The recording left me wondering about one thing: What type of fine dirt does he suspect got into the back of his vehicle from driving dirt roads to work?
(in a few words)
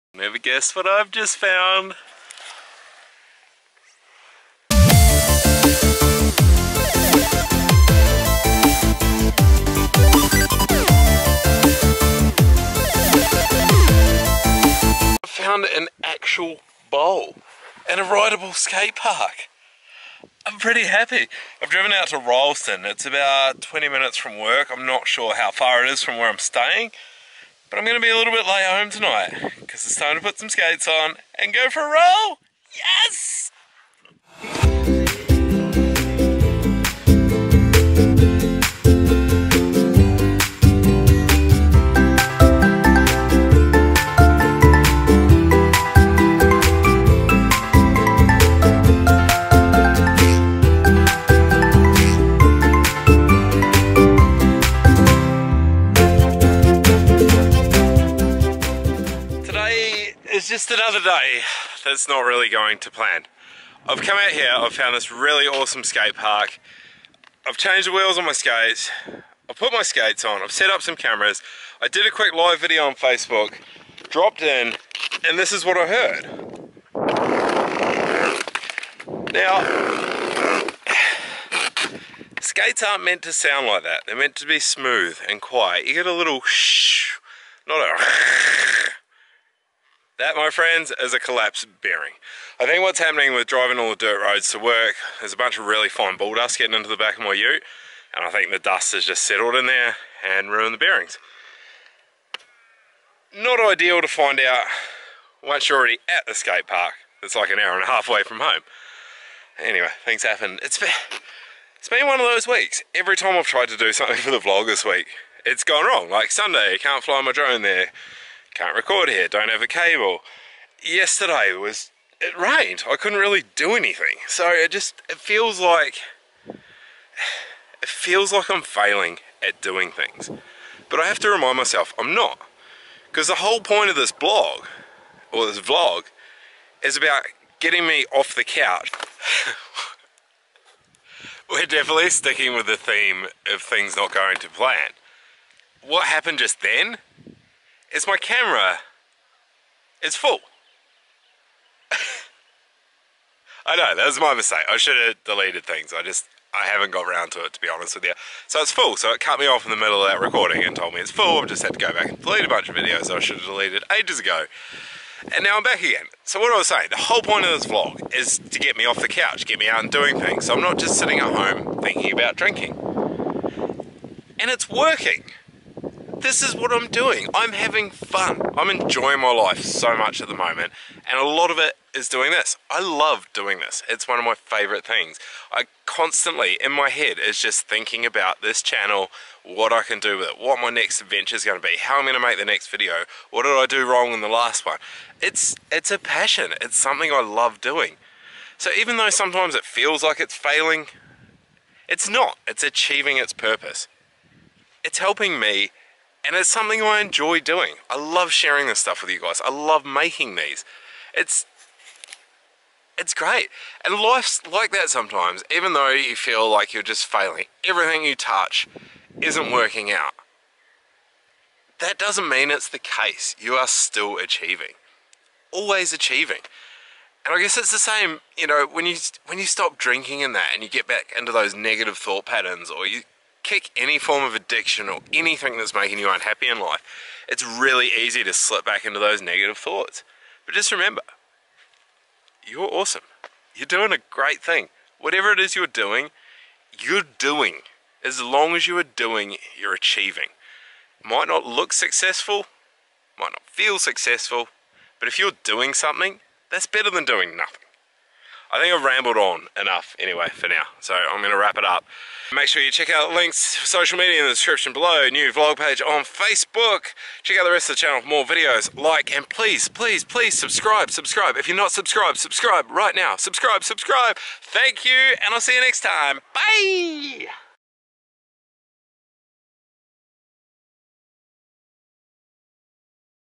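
bull dust.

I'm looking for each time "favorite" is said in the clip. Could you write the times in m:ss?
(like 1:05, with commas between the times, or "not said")
3:04.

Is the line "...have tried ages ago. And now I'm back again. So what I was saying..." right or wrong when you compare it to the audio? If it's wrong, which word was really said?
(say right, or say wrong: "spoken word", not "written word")
wrong: "deleted", not "tried".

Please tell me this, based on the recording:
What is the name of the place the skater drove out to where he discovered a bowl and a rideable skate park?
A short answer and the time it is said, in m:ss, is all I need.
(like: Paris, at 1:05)
Ralston, at 0:22.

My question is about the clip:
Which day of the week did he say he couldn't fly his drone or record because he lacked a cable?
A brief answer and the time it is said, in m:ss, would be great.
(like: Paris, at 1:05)
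Sunday, at 1:56.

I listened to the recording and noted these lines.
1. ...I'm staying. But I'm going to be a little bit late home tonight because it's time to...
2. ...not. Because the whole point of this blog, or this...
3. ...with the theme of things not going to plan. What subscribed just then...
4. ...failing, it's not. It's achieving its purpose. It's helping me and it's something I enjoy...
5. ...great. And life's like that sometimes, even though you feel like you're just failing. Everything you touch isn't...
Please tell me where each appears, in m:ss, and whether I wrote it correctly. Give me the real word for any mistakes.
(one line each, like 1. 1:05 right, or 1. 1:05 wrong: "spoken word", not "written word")
1. 0:26 right
2. 2:12 right
3. 2:22 wrong: "happened", not "subscribed"
4. 3:20 right
5. 3:33 right.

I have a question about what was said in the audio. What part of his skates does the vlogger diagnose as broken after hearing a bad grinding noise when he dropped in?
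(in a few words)
collapsed bearing.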